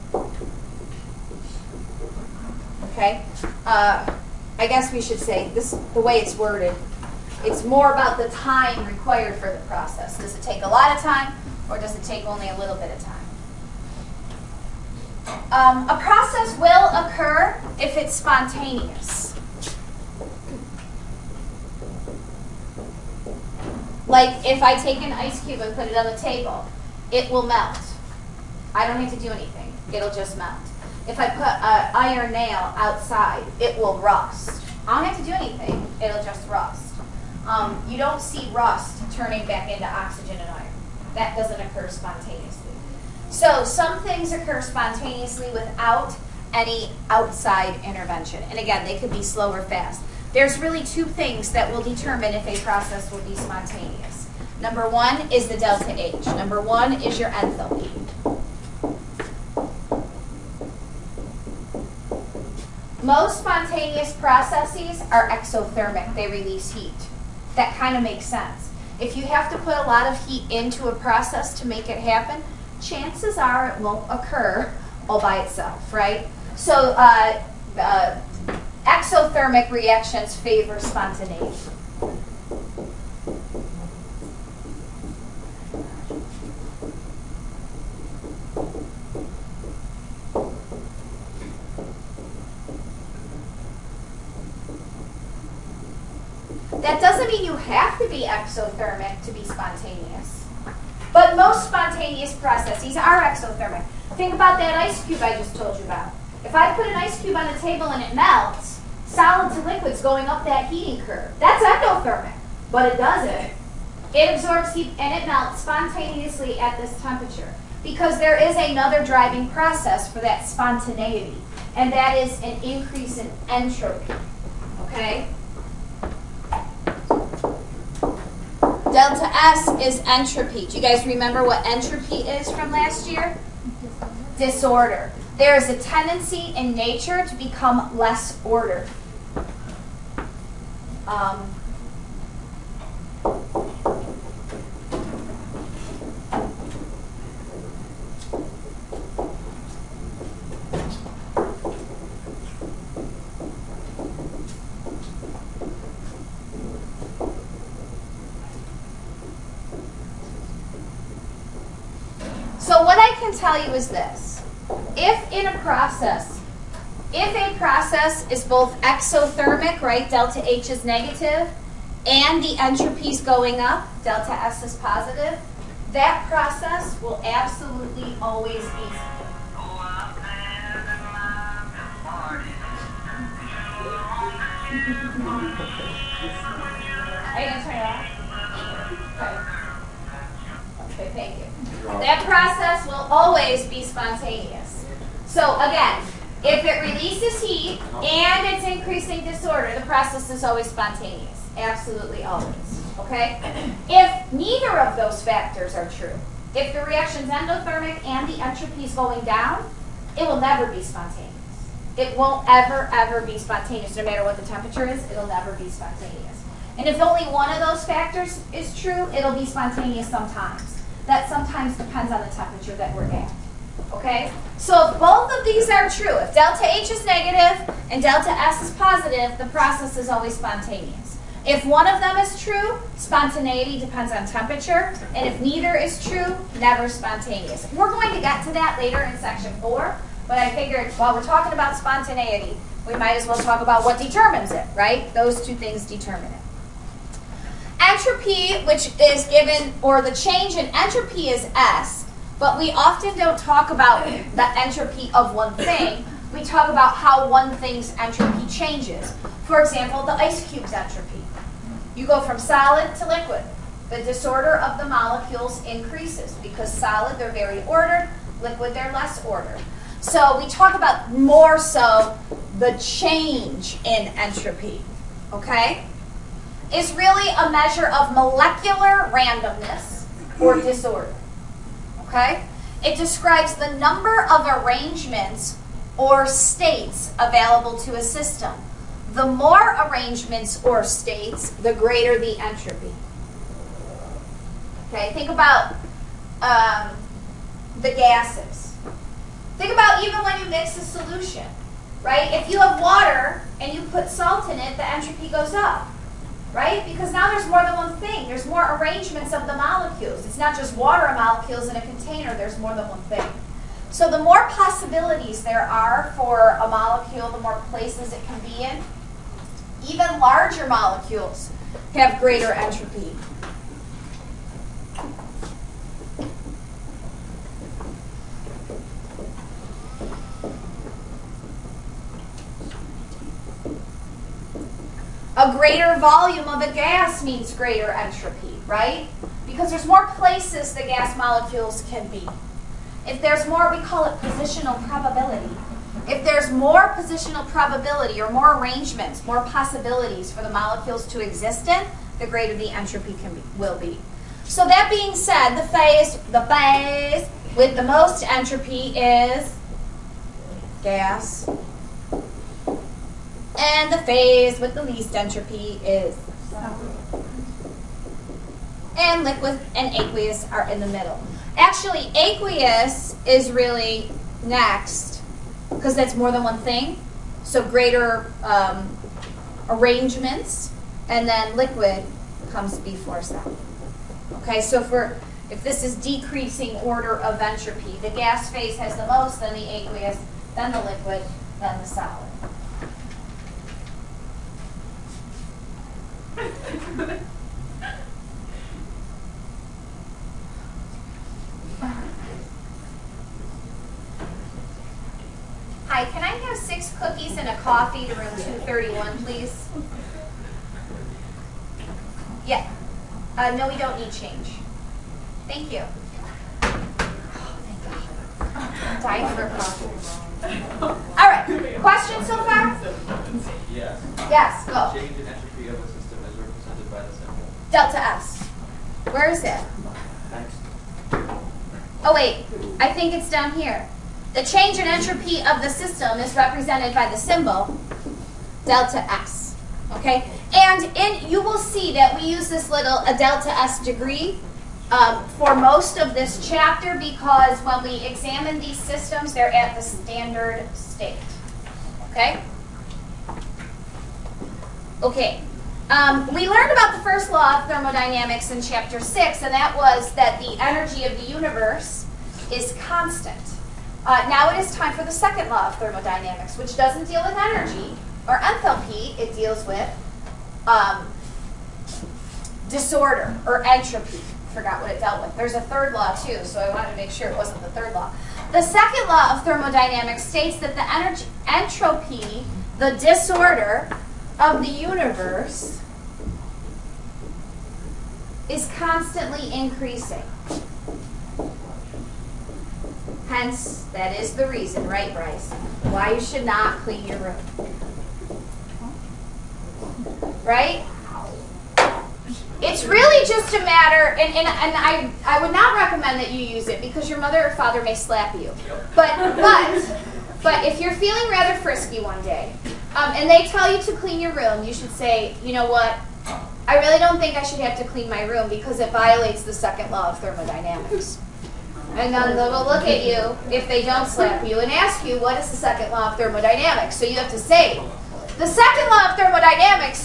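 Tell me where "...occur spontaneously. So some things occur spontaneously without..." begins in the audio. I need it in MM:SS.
00:41.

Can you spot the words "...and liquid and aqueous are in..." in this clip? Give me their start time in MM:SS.
06:08.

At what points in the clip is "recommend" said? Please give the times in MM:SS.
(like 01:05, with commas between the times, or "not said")
08:25.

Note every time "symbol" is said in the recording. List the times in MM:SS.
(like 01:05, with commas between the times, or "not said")
07:07, 07:17.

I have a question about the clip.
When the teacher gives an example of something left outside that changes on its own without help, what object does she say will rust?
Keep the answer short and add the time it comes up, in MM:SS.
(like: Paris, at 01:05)
iron nail, at 00:31.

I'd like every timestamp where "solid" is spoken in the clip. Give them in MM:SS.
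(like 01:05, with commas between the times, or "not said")
01:49, 04:22, 04:26, 06:23, 06:31.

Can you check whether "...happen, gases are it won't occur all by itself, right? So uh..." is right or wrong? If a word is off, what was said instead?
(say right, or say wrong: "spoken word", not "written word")
wrong: "chances", not "gases".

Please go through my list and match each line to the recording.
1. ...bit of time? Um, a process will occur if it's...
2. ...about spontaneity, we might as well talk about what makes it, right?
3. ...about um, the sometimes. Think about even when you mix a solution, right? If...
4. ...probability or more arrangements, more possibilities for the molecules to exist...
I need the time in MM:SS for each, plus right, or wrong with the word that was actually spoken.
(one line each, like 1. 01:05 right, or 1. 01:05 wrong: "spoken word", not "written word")
1. 00:12 right
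2. 04:01 wrong: "determines", not "makes"
3. 04:55 wrong: "gases", not "sometimes"
4. 05:47 right.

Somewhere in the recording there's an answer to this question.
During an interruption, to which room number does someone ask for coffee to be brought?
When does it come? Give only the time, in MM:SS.
06:48.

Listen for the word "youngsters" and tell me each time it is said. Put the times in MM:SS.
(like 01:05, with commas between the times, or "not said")
not said.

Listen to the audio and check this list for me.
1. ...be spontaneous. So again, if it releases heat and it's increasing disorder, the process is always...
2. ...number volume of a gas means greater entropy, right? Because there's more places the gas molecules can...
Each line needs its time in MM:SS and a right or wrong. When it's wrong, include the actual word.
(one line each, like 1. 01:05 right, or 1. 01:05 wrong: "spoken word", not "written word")
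1. 03:13 right
2. 05:35 wrong: "greater", not "number".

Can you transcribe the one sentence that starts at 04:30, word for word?
So we talk about more so the change in entropy, okay?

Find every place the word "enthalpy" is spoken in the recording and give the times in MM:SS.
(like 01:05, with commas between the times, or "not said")
00:57, 07:48.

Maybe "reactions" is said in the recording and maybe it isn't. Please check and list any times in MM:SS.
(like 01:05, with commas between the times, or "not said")
01:19, 03:26.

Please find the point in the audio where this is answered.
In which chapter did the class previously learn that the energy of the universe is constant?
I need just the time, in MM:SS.
07:38.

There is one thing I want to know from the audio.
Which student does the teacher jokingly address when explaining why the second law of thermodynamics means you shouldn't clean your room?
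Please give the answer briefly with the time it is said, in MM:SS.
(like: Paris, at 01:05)
Bryce, at 08:15.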